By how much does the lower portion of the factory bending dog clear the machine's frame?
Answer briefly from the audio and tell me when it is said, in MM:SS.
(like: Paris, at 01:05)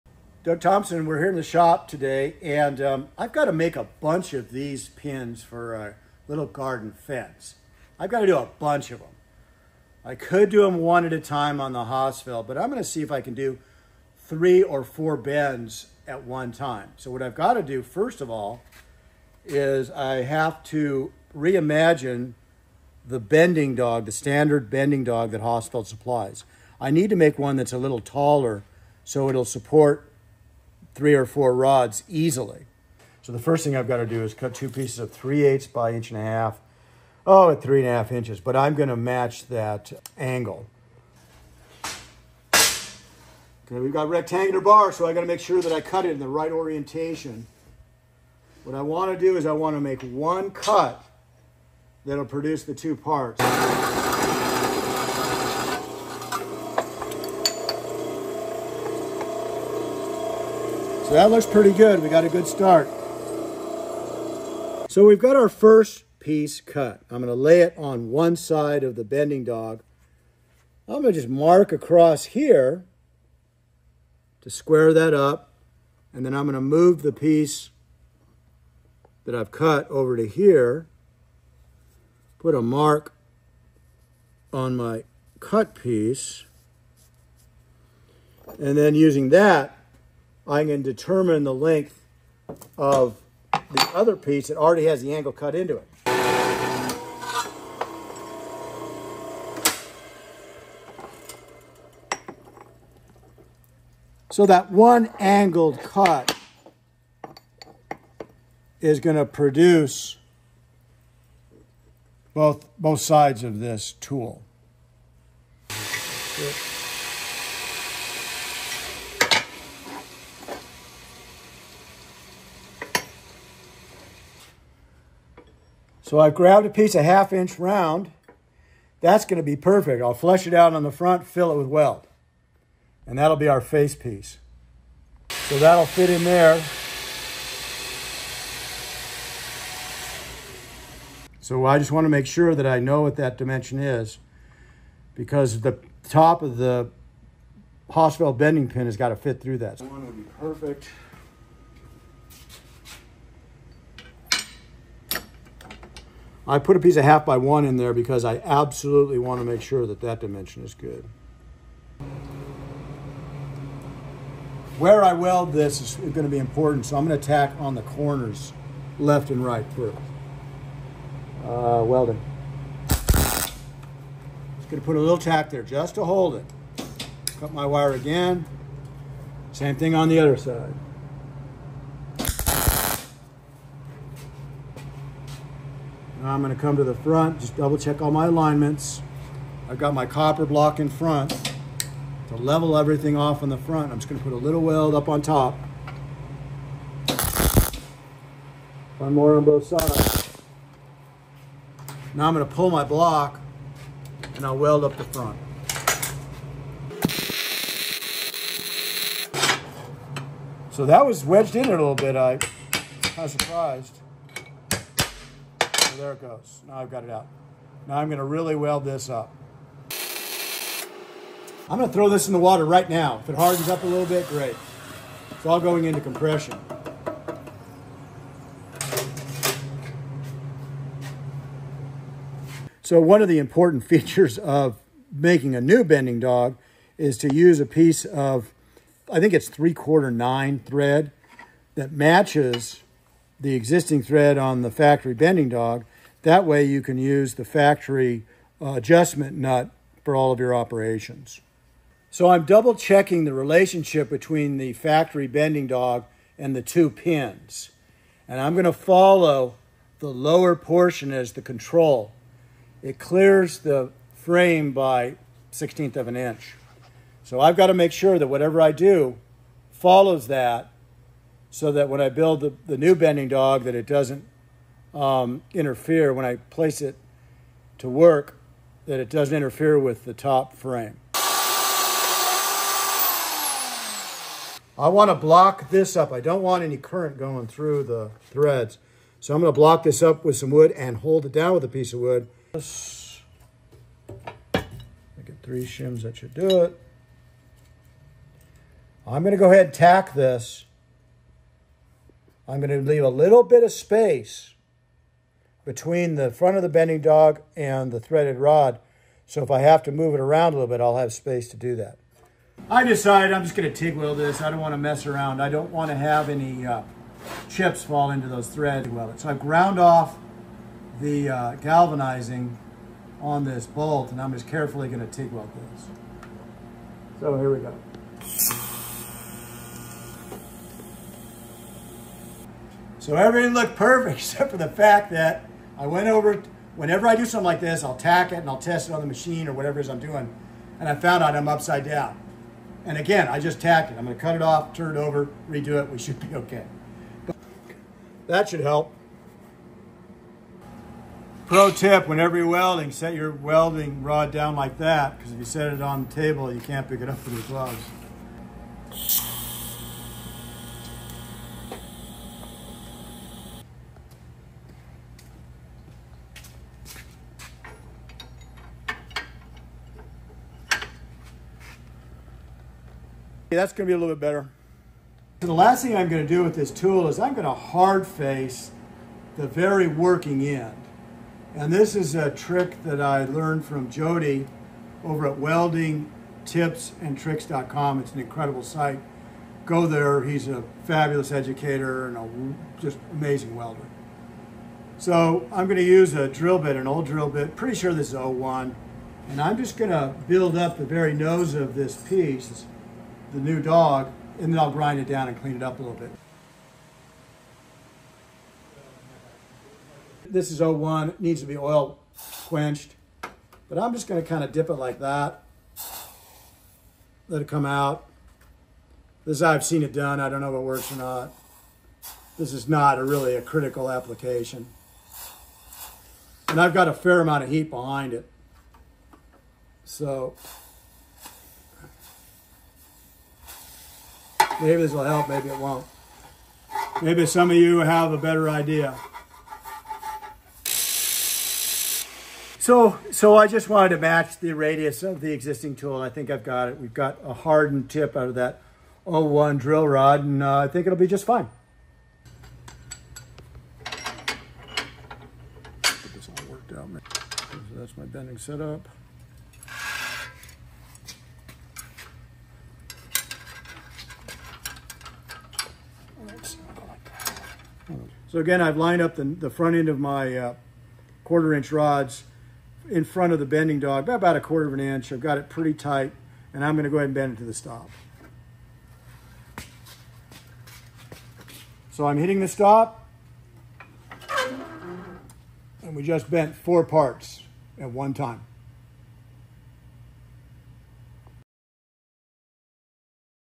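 1/16 inch, at 04:25.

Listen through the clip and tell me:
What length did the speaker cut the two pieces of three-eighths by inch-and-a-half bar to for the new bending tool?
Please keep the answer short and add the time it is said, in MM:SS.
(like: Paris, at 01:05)
3.5 inches, at 00:37.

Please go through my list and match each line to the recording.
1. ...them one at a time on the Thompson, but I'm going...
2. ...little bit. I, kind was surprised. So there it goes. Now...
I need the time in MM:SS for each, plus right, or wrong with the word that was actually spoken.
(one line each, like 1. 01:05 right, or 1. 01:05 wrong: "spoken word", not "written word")
1. 00:10 wrong: "Hossfeld", not "Thompson"
2. 03:31 right.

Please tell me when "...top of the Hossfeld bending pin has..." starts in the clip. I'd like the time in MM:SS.
02:26.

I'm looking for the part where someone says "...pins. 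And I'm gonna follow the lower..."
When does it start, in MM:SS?
04:16.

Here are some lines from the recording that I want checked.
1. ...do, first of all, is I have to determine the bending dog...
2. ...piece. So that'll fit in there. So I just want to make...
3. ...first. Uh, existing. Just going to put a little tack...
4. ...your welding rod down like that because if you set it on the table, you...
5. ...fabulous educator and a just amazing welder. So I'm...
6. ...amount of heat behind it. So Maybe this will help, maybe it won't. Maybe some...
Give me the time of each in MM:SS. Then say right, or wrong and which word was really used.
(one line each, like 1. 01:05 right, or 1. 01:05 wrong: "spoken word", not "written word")
1. 00:17 wrong: "reimagine", not "determine"
2. 02:13 right
3. 02:49 wrong: "welding", not "existing"
4. 05:53 right
5. 06:30 right
6. 07:07 right.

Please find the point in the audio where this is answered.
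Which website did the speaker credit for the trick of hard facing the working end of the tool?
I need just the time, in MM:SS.
06:25.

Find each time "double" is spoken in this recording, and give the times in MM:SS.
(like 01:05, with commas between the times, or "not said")
03:07, 04:12.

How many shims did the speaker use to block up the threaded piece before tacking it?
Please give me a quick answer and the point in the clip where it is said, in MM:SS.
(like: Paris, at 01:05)
3, at 04:55.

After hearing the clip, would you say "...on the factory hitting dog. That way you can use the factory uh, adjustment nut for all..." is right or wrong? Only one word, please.
wrong.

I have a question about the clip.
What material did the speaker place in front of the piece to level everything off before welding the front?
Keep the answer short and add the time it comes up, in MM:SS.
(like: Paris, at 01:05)
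Copper block, at 03:10.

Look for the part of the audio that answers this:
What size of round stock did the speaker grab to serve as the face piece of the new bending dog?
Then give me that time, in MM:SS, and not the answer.
02:06.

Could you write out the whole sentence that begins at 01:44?
So that one angled cut is going to produce both both sides of this tool.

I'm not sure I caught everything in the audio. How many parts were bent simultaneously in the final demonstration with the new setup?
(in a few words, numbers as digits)
4.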